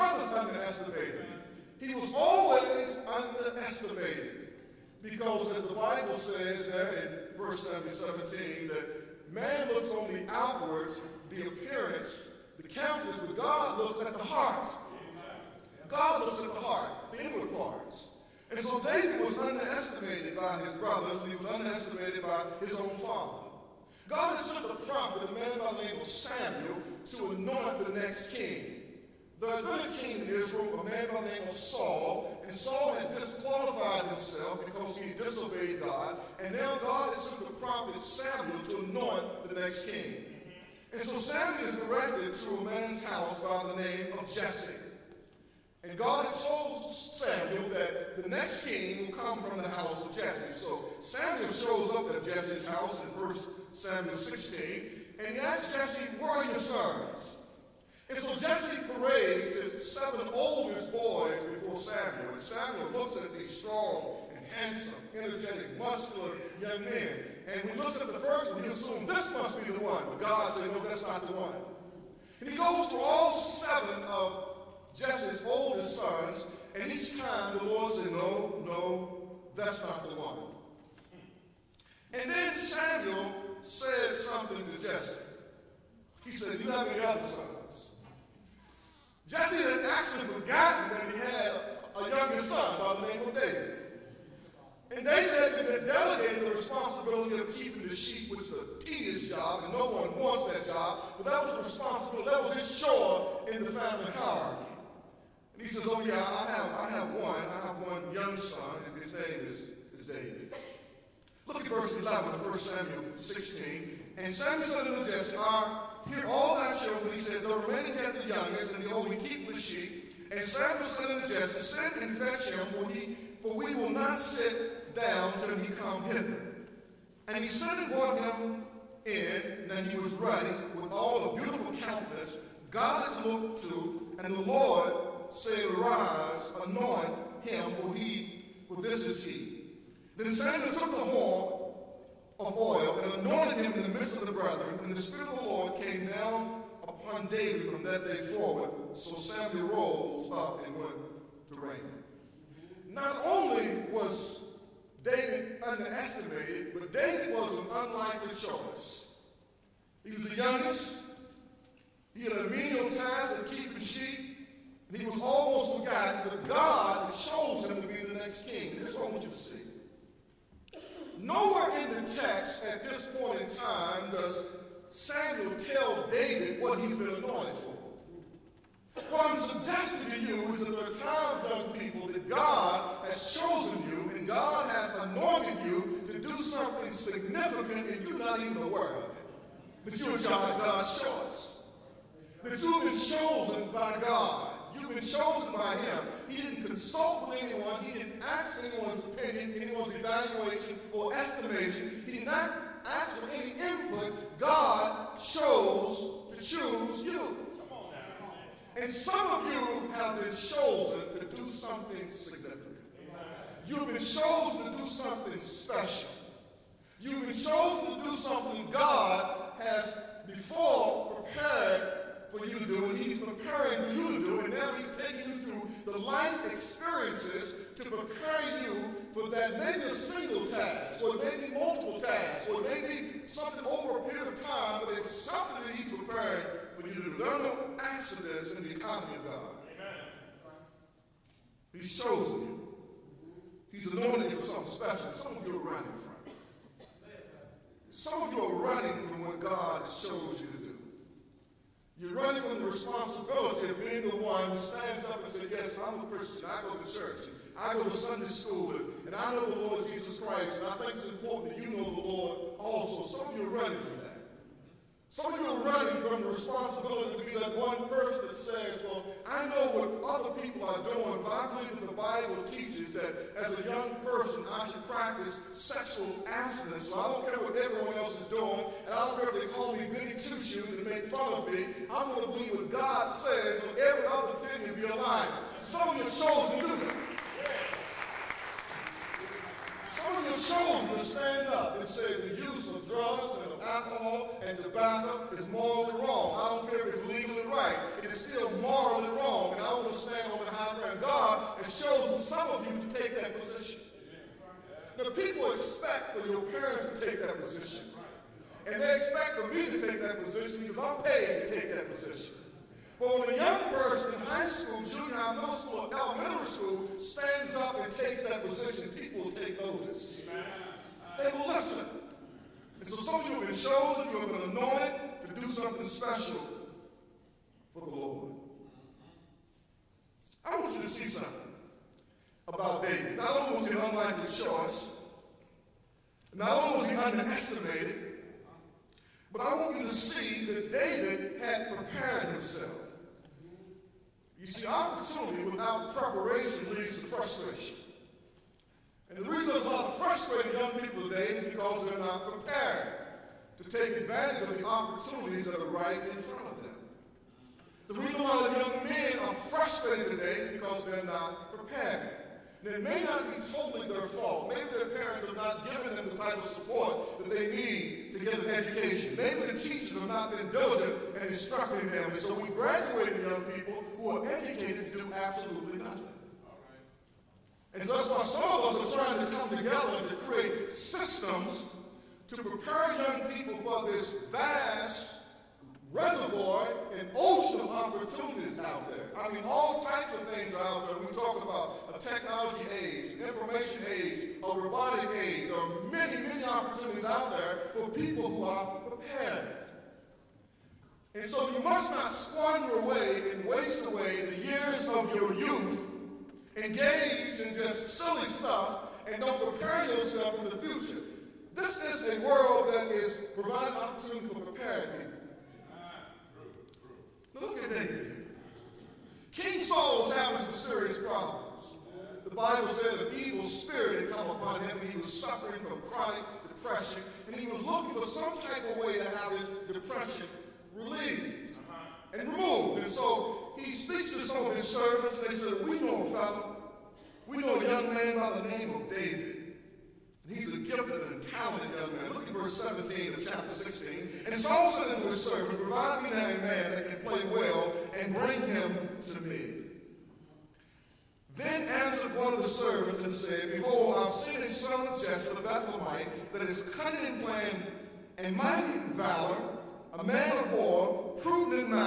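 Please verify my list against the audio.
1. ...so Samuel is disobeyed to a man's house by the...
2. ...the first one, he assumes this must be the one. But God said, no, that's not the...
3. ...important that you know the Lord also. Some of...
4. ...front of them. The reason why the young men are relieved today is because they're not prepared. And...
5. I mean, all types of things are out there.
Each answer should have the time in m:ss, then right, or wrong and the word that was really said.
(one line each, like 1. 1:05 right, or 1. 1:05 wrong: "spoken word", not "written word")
1. 0:40 wrong: "directed", not "disobeyed"
2. 1:08 right
3. 4:21 right
4. 5:56 wrong: "frustrated", not "relieved"
5. 6:29 right.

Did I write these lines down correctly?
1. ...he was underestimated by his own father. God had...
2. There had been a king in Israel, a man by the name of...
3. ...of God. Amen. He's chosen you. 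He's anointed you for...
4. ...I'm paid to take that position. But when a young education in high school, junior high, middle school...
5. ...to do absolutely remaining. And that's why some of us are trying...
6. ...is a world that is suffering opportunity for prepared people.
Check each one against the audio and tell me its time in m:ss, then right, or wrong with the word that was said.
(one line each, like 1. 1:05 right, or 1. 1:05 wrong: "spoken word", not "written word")
1. 0:21 right
2. 0:29 right
3. 3:59 right
4. 5:10 wrong: "person", not "education"
5. 6:14 wrong: "nothing", not "remaining"
6. 6:51 wrong: "providing", not "suffering".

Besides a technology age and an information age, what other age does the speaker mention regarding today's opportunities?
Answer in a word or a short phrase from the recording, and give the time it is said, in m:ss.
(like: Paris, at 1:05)
robotic age, at 6:34.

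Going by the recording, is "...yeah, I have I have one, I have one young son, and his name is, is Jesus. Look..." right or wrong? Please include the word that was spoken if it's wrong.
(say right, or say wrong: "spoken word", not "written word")
wrong: "David", not "Jesus".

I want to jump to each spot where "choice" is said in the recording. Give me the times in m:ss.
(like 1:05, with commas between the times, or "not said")
2:38, 3:11, 5:34.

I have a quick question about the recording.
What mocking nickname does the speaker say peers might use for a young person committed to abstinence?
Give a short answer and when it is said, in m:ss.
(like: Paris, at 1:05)
Billy two-shoes, at 4:39.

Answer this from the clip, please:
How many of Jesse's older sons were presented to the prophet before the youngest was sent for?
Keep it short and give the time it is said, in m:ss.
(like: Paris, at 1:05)
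7, at 0:59.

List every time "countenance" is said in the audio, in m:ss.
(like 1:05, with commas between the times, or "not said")
0:12, 2:11.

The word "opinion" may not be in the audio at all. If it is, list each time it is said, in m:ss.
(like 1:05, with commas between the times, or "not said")
3:18, 4:44.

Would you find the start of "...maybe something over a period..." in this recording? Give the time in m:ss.
3:52.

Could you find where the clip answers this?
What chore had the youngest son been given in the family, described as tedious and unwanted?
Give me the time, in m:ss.
1:37.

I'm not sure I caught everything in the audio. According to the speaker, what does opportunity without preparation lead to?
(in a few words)
frustration.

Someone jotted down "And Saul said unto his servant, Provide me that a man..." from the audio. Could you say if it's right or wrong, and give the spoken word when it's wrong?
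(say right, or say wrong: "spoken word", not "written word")
right.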